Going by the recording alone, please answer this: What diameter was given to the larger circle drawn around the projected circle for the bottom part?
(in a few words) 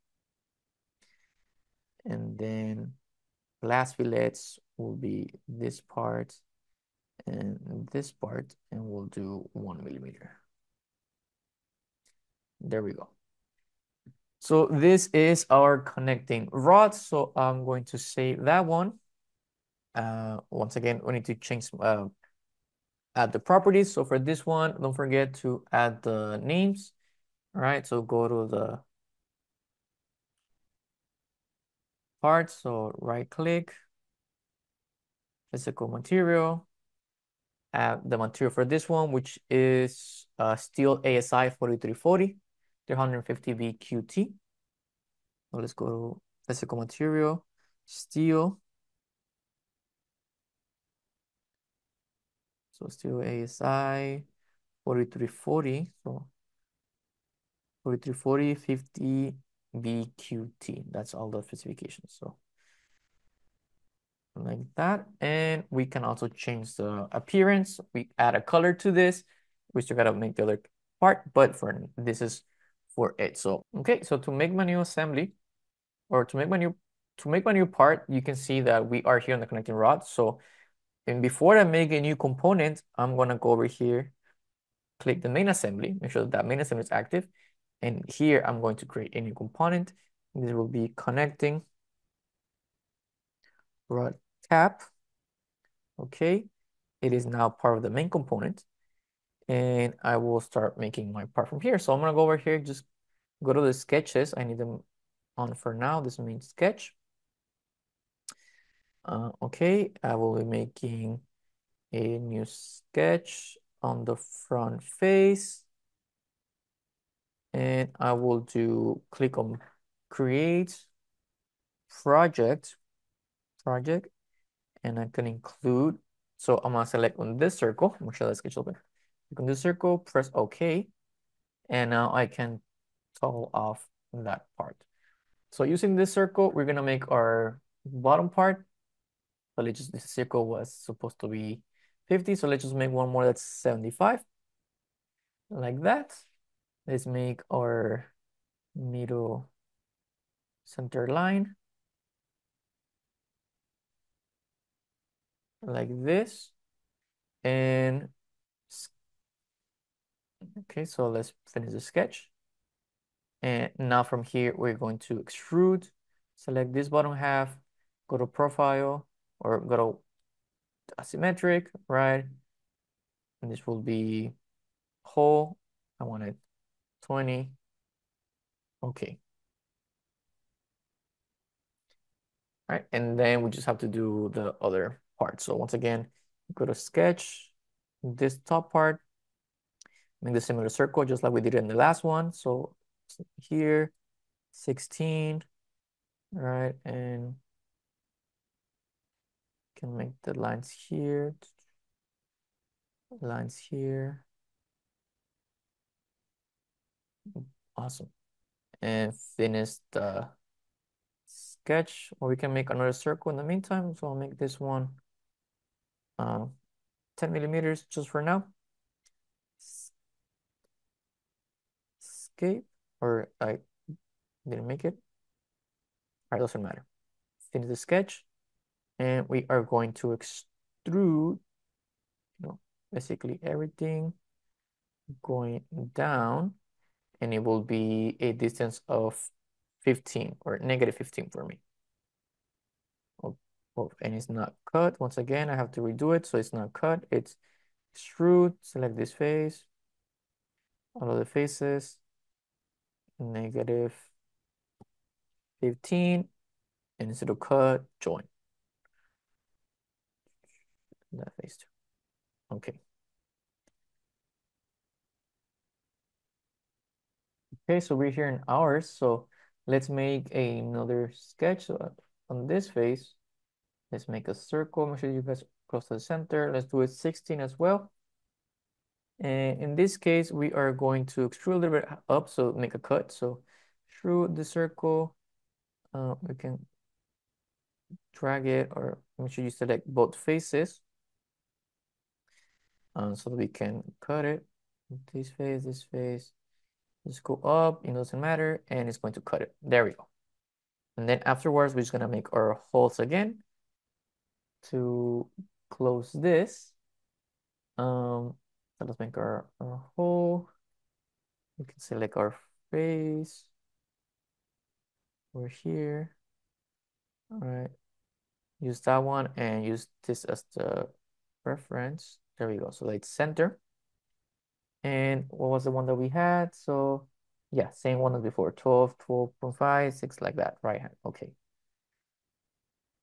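75.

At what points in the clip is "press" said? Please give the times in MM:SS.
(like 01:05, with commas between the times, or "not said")
02:09.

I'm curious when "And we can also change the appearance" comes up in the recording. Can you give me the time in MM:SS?
01:05.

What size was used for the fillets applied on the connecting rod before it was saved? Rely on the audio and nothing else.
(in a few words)
1 millimeter.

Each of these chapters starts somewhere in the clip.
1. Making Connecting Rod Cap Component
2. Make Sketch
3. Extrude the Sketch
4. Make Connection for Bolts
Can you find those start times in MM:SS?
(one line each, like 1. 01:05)
1. 01:15
2. 01:49
3. 02:42
4. 03:03.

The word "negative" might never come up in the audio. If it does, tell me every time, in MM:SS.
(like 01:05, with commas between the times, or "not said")
04:00, 04:13.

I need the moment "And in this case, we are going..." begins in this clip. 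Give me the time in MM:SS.
04:39.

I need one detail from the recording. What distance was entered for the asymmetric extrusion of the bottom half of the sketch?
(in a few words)
20.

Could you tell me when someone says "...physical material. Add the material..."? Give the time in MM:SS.
00:35.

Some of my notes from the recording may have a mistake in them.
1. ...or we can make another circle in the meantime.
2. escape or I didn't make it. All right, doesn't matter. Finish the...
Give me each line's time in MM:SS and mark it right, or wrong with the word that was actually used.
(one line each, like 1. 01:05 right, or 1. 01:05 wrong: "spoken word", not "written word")
1. 03:32 right
2. 03:42 right.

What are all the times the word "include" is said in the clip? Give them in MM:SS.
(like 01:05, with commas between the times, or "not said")
02:05.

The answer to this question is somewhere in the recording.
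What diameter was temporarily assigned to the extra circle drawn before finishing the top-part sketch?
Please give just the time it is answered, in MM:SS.
03:37.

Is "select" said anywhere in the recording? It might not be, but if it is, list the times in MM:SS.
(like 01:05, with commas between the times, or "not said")
02:06, 02:46, 04:08, 04:49, 05:11.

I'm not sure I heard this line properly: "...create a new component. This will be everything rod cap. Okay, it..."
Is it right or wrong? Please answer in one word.
wrong.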